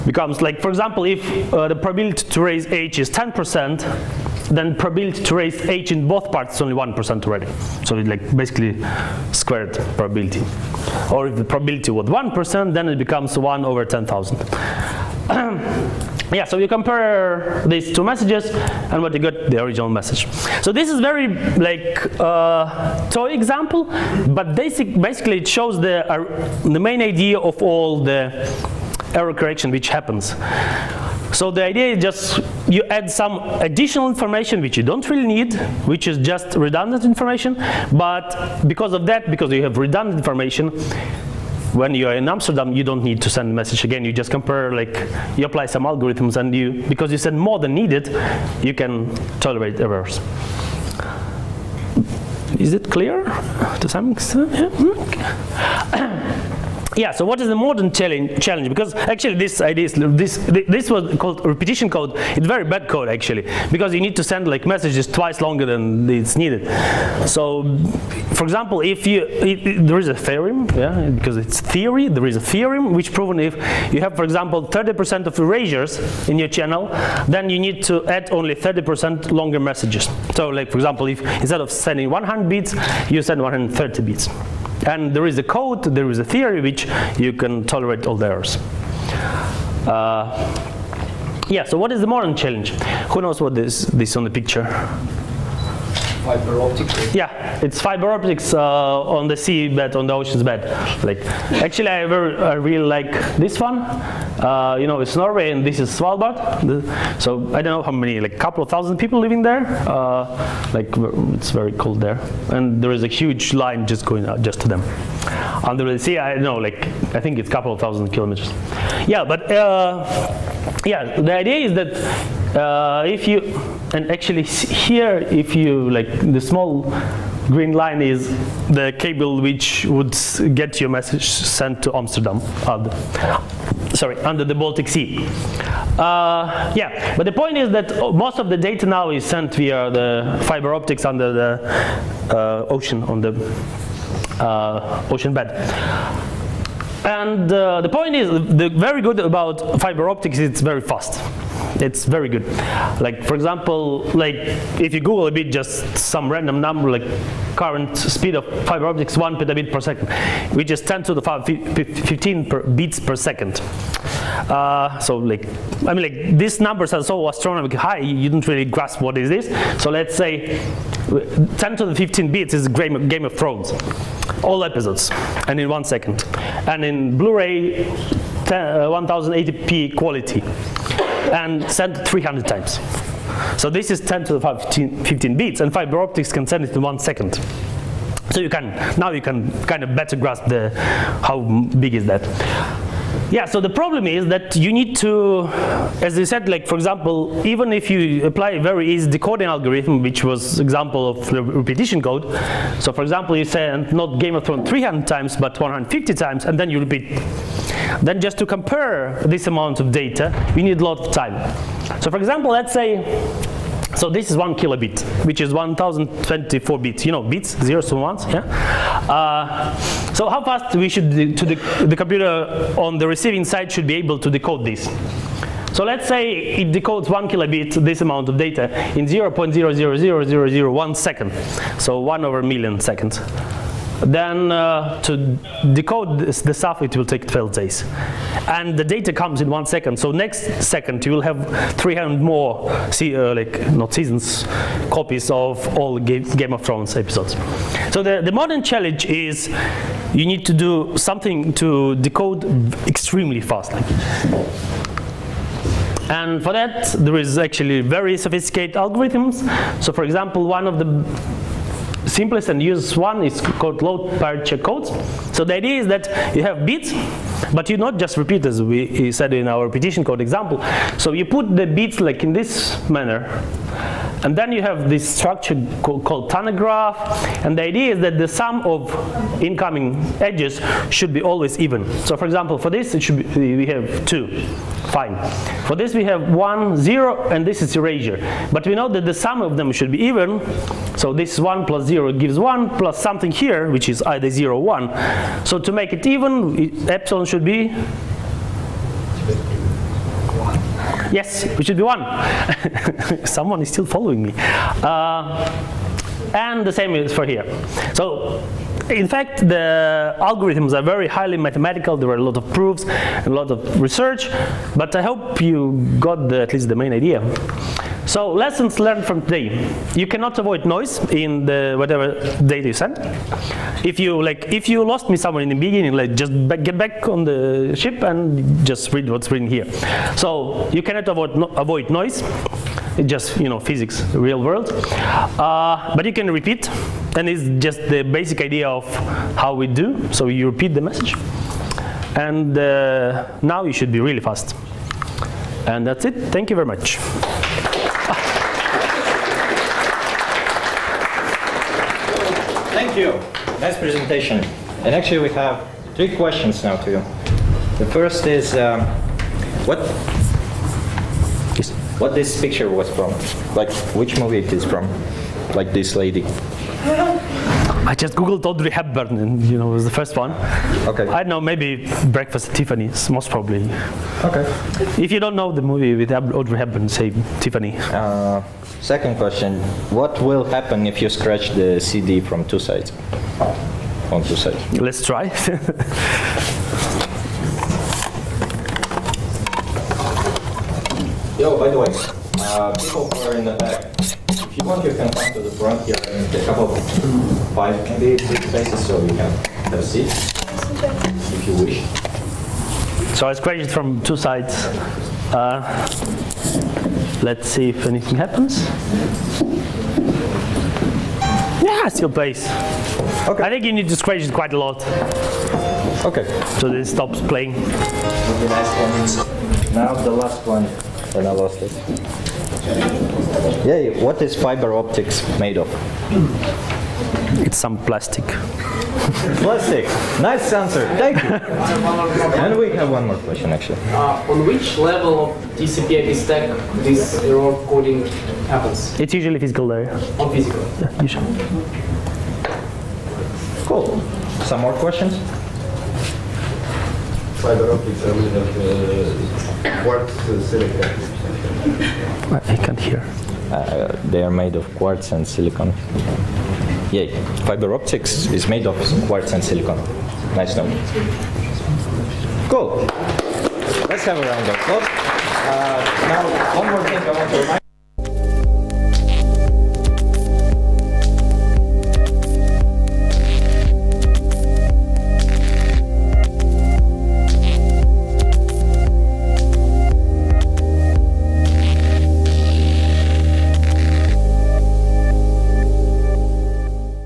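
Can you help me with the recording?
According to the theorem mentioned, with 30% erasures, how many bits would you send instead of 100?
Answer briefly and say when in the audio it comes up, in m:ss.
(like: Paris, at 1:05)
130, at 1:23.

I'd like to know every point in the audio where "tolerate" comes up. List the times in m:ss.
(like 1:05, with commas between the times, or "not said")
0:49, 1:27.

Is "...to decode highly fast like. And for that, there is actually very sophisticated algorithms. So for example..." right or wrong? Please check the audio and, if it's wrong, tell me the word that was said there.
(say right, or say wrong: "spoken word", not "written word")
wrong: "extremely", not "highly".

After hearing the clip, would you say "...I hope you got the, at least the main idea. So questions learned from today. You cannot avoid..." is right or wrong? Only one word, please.
wrong.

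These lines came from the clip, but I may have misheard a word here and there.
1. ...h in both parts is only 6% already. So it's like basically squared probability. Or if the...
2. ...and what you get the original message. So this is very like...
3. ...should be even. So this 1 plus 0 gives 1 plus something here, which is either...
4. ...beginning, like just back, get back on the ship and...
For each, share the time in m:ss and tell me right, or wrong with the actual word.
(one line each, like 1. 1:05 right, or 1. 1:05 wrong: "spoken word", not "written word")
1. 0:05 wrong: "1", not "6"
2. 0:18 right
3. 4:49 right
4. 5:25 right.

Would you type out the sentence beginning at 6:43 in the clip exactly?
So I scratched it from two sides.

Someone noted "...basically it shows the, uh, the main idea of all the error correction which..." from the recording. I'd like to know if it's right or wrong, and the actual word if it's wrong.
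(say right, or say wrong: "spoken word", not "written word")
right.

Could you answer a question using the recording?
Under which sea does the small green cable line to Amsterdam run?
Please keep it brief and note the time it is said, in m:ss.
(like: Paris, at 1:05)
Baltic Sea, at 2:14.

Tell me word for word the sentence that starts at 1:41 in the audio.
Like, actually, I, I really like this one.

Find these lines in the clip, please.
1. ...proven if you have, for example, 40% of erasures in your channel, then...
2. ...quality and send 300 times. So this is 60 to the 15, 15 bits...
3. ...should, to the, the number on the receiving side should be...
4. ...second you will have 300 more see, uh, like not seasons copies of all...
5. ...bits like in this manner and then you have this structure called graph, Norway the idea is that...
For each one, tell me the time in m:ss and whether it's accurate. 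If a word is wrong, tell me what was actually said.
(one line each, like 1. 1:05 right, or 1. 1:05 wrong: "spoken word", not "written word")
1. 1:13 wrong: "30", not "40"
2. 2:59 wrong: "10", not "60"
3. 3:40 wrong: "computer", not "number"
4. 4:00 right
5. 4:31 wrong: "And", not "Norway".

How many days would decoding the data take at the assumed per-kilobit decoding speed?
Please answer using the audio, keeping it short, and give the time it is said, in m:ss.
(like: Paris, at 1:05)
12, at 3:57.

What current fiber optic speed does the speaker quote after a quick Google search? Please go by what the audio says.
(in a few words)
1 petabit per second.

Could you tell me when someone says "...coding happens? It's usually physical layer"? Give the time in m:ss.
7:17.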